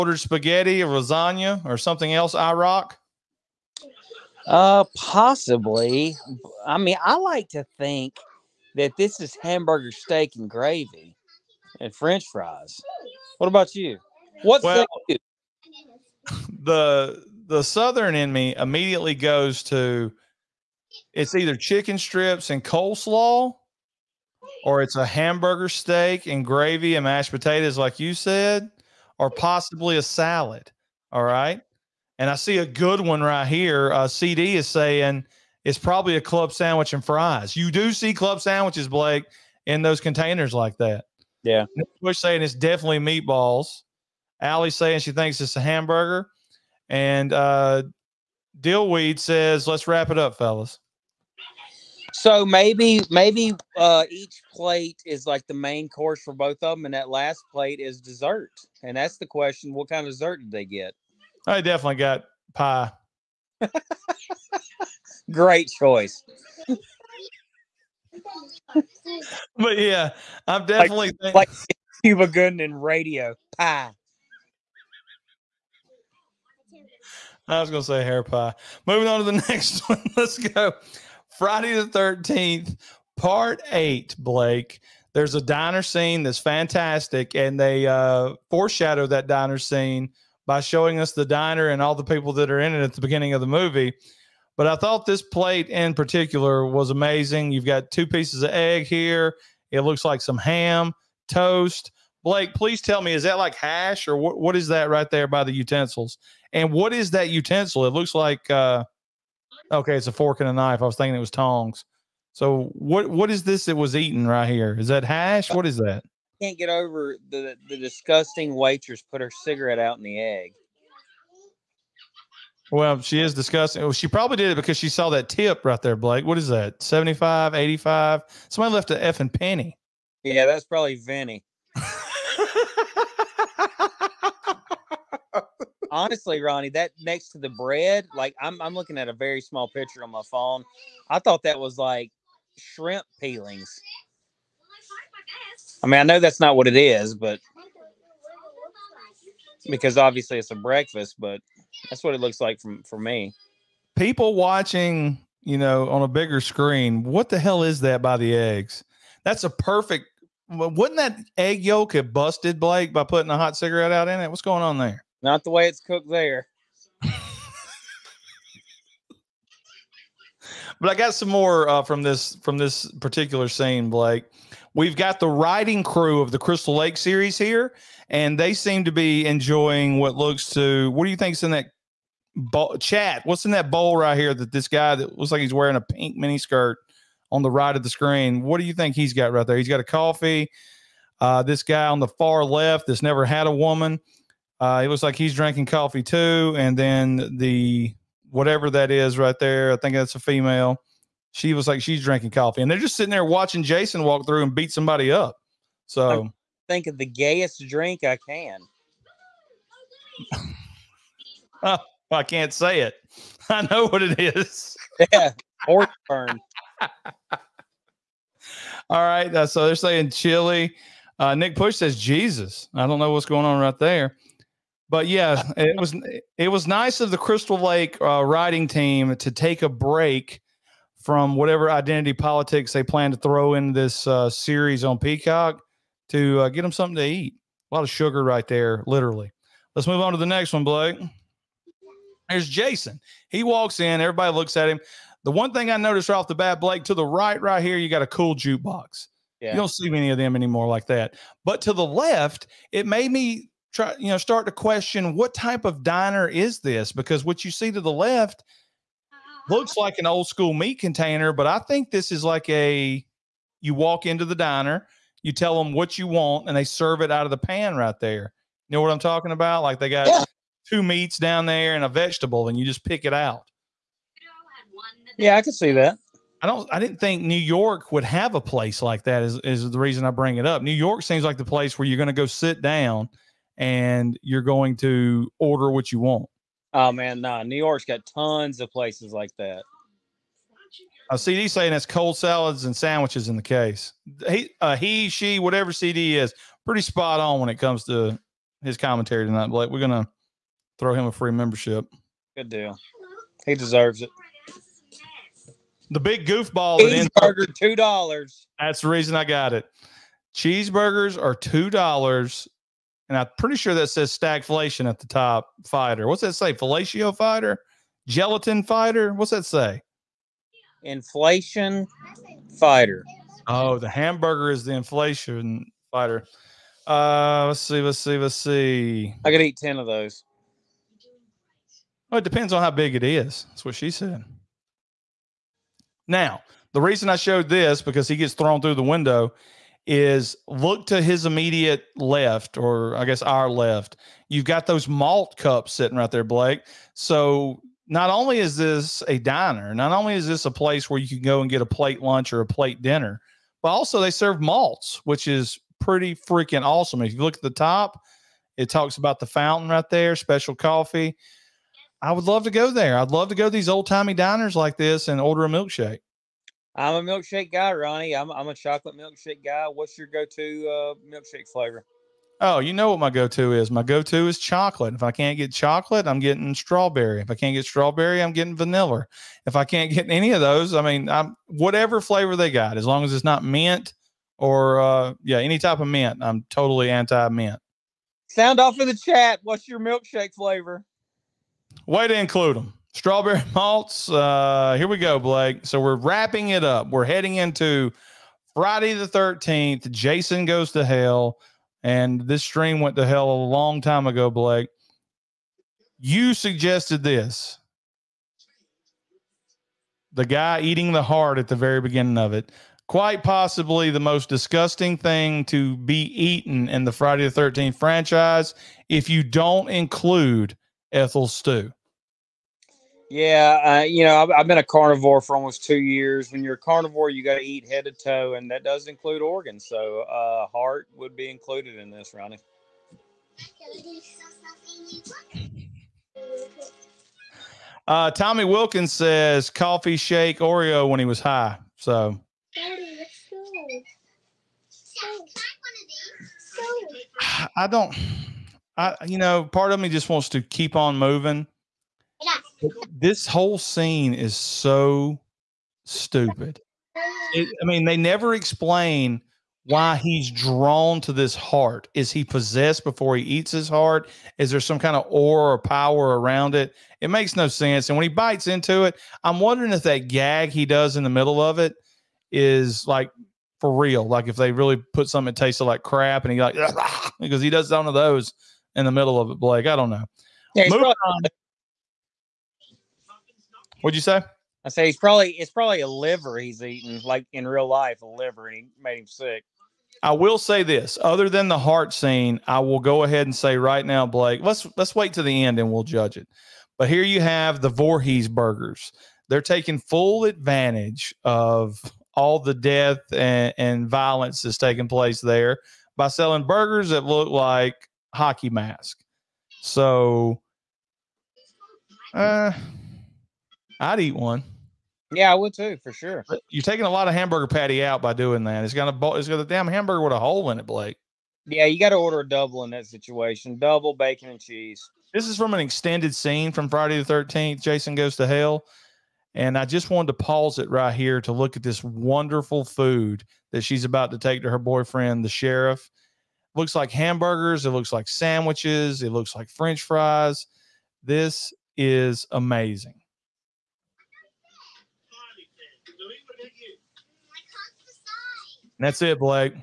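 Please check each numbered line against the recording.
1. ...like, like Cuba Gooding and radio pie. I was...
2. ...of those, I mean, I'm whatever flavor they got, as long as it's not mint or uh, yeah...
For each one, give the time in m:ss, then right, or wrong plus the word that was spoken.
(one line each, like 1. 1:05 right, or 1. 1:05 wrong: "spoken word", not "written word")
1. 1:11 right
2. 6:20 right.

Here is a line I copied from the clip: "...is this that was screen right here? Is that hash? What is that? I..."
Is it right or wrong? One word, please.
wrong.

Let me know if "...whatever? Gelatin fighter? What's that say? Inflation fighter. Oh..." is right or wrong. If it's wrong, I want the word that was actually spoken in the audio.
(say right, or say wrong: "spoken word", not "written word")
wrong: "fighter", not "whatever".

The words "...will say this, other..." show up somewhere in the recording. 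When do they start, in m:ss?
8:10.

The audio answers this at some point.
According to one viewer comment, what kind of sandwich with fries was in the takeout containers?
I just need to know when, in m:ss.
0:36.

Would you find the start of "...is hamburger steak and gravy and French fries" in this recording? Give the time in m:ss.
0:09.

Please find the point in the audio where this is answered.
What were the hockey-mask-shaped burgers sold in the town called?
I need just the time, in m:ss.
8:17.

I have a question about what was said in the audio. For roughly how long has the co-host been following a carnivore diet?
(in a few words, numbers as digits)
Almost two years.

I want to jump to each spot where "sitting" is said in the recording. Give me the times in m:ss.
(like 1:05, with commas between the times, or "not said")
3:22, 5:45.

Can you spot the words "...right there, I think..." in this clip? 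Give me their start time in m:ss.
3:19.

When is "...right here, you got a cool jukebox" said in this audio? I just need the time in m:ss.
4:07.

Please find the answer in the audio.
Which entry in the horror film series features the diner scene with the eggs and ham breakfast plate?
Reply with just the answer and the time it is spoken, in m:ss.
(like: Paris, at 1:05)
Part eight, at 1:23.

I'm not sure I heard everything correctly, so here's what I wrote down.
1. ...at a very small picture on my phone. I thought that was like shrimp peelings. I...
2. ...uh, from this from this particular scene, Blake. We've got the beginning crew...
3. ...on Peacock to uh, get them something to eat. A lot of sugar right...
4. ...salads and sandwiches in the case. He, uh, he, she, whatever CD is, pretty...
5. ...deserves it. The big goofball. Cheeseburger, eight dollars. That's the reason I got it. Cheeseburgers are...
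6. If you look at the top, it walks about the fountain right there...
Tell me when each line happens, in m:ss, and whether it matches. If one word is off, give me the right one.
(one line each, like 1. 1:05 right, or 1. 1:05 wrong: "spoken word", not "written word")
1. 2:18 right
2. 2:51 wrong: "riding", not "beginning"
3. 3:54 right
4. 4:52 right
5. 5:03 wrong: "two", not "eight"
6. 5:57 wrong: "talks", not "walks".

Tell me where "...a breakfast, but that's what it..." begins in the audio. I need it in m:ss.
2:30.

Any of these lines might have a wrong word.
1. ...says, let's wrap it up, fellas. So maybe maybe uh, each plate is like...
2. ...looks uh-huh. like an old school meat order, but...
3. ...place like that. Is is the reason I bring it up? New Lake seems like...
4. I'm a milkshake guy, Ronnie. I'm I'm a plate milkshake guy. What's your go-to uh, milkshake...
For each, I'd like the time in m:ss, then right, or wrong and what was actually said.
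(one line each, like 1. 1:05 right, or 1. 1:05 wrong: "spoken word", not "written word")
1. 0:49 right
2. 4:19 wrong: "container", not "order"
3. 4:38 wrong: "York", not "Lake"
4. 6:06 wrong: "chocolate", not "plate".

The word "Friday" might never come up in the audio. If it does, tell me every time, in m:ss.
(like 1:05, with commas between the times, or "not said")
1:21, 6:38, 6:56, 8:46.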